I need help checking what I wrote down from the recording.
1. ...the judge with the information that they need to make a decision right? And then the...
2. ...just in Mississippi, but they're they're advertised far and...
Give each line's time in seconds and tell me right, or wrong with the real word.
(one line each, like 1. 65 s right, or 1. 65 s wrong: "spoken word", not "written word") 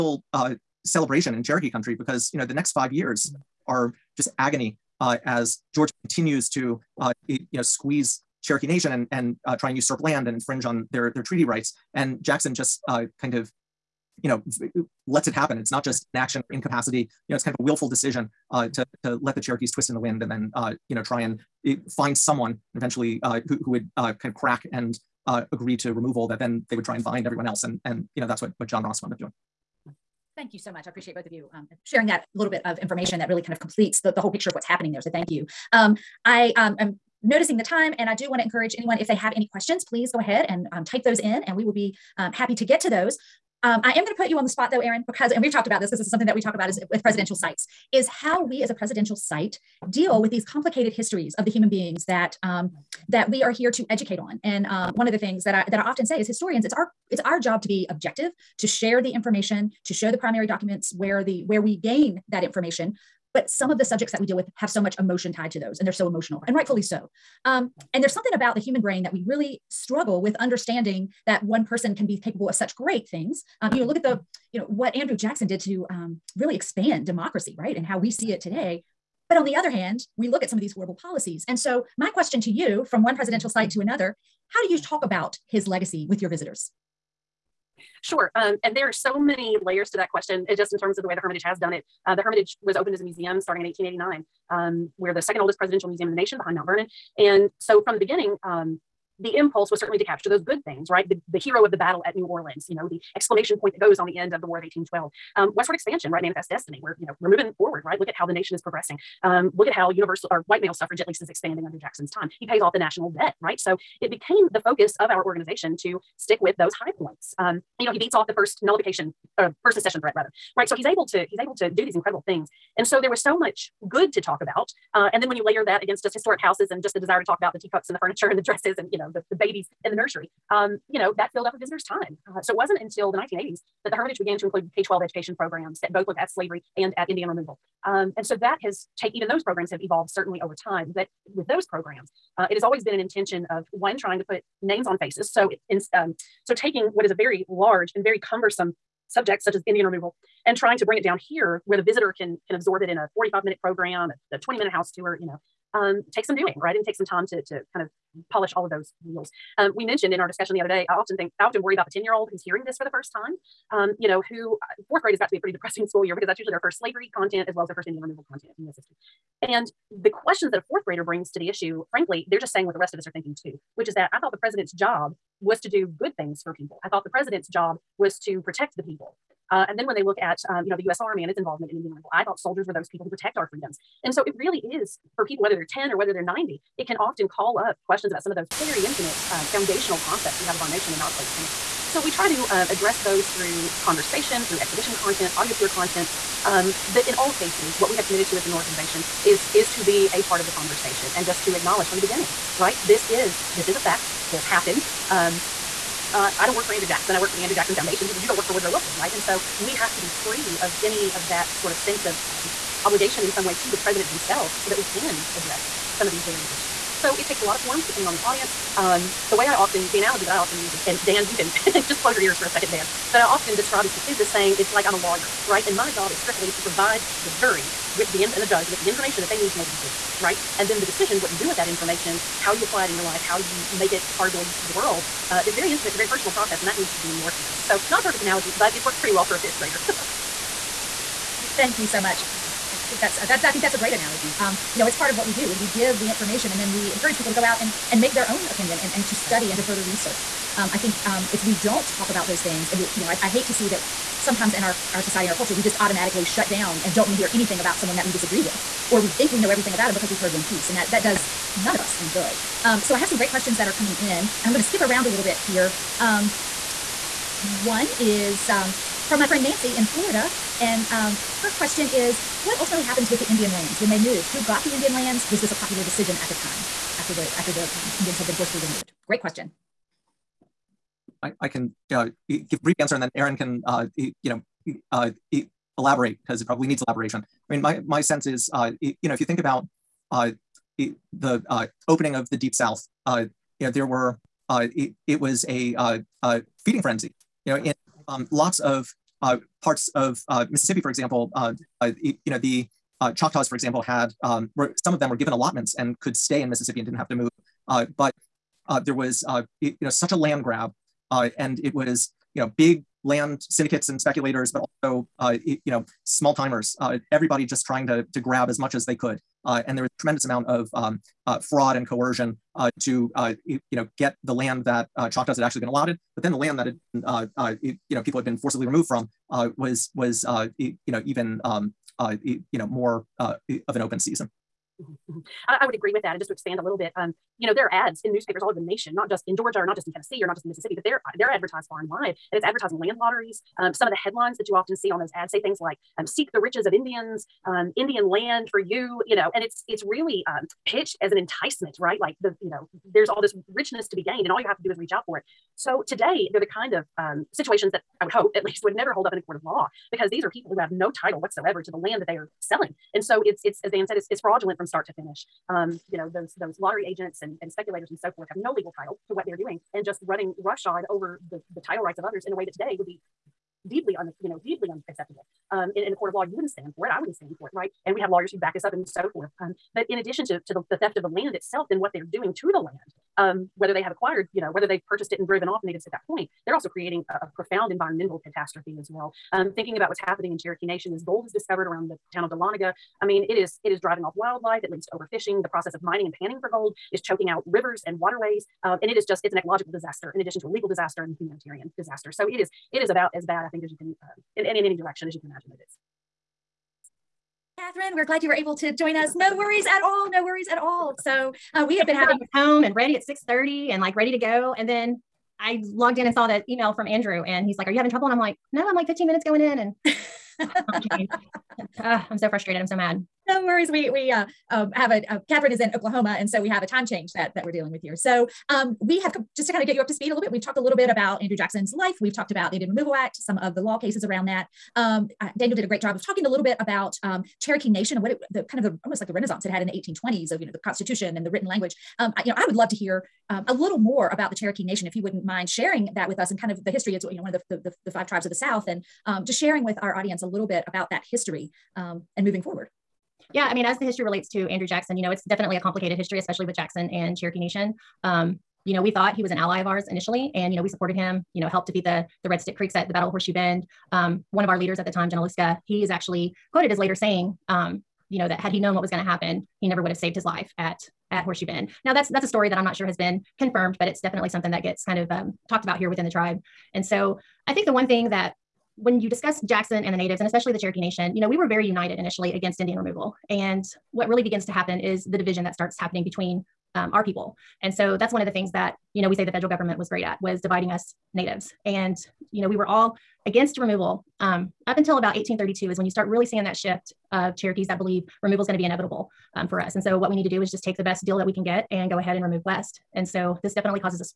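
1. 228 s right
2. 340 s right.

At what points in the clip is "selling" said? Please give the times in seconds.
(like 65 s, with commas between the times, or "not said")
362 s.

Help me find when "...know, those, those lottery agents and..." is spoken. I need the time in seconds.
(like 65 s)
365 s.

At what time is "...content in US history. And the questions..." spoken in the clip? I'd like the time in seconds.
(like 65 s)
168 s.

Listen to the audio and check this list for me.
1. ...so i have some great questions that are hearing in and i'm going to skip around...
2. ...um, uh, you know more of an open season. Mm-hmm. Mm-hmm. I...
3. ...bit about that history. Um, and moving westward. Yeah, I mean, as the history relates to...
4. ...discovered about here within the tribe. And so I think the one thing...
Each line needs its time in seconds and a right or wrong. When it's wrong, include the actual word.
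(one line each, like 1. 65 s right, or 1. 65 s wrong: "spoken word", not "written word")
1. 262 s wrong: "coming", not "hearing"
2. 331 s right
3. 450 s wrong: "forward", not "westward"
4. 475 s wrong: "talked", not "discovered".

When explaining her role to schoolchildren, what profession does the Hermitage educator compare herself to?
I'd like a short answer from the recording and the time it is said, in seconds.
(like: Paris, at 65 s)
Lawyer, at 224 s.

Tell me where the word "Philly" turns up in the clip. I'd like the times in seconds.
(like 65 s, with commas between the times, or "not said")
not said.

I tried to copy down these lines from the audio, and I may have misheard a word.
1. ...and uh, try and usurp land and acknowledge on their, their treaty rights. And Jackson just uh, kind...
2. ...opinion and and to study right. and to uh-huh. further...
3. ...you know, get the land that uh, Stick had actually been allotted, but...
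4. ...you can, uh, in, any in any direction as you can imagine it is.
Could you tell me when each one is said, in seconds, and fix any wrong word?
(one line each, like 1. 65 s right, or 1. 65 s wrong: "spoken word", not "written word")
1. 9 s wrong: "infringe", not "acknowledge"
2. 248 s right
3. 323 s wrong: "Choctaws", not "Stick"
4. 403 s right.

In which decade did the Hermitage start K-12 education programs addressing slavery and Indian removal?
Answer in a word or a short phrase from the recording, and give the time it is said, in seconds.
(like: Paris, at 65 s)
1980s, at 133 s.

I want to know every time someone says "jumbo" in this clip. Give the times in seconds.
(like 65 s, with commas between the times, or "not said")
not said.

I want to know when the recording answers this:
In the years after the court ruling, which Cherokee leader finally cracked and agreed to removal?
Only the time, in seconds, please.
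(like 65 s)
28 s.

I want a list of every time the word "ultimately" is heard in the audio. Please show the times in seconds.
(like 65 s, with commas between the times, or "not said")
272 s.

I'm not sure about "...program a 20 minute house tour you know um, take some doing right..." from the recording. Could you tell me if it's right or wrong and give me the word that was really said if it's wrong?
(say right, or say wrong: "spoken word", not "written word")
right.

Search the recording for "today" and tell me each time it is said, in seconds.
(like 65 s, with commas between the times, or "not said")
78 s, 355 s, 372 s.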